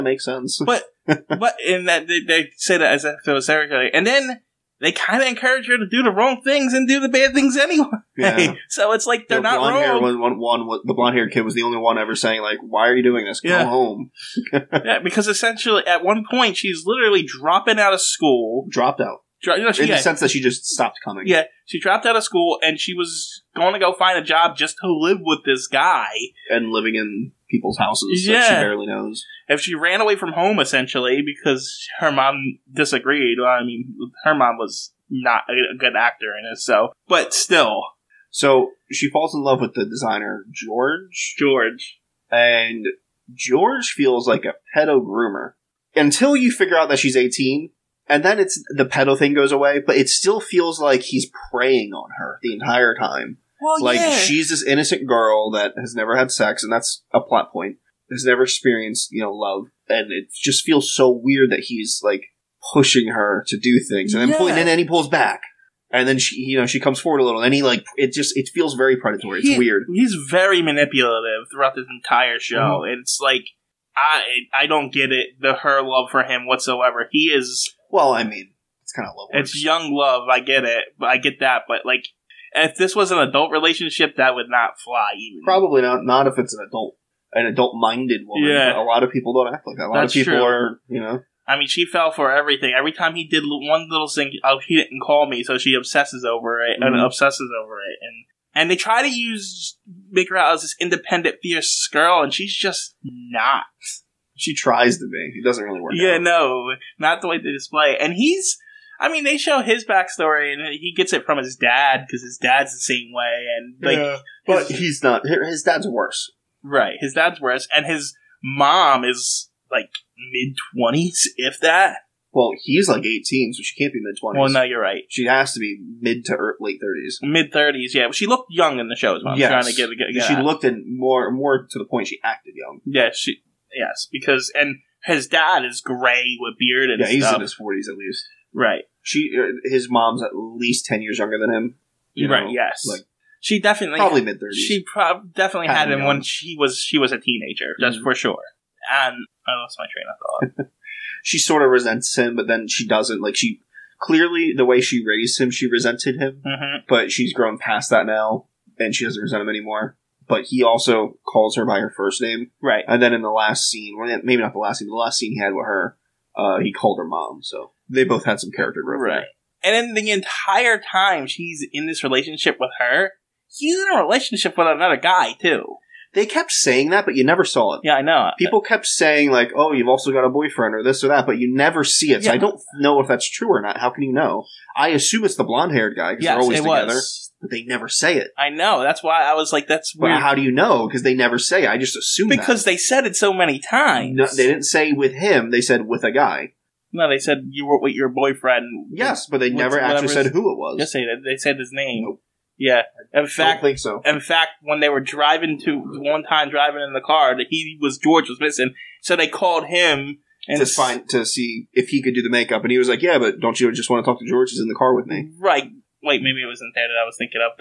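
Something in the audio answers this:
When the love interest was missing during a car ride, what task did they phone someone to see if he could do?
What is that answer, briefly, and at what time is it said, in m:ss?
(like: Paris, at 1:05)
makeup, at 3:32.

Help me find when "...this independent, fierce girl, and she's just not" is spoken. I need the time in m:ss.
1:40.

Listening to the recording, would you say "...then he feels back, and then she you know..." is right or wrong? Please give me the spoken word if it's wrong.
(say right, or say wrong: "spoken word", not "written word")
wrong: "pulls", not "feels".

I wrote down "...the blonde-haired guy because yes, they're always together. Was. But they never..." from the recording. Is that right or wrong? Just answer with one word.
right.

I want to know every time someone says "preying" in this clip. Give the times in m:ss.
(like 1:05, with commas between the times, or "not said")
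0:51.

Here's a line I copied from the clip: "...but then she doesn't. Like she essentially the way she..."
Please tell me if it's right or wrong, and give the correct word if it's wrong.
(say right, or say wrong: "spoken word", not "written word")
wrong: "clearly", not "essentially".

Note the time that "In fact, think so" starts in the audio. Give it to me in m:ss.
3:23.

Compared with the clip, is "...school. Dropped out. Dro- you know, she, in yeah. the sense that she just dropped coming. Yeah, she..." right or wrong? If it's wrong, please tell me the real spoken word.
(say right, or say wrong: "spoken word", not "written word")
wrong: "stopped", not "dropped".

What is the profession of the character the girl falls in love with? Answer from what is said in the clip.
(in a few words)
designer.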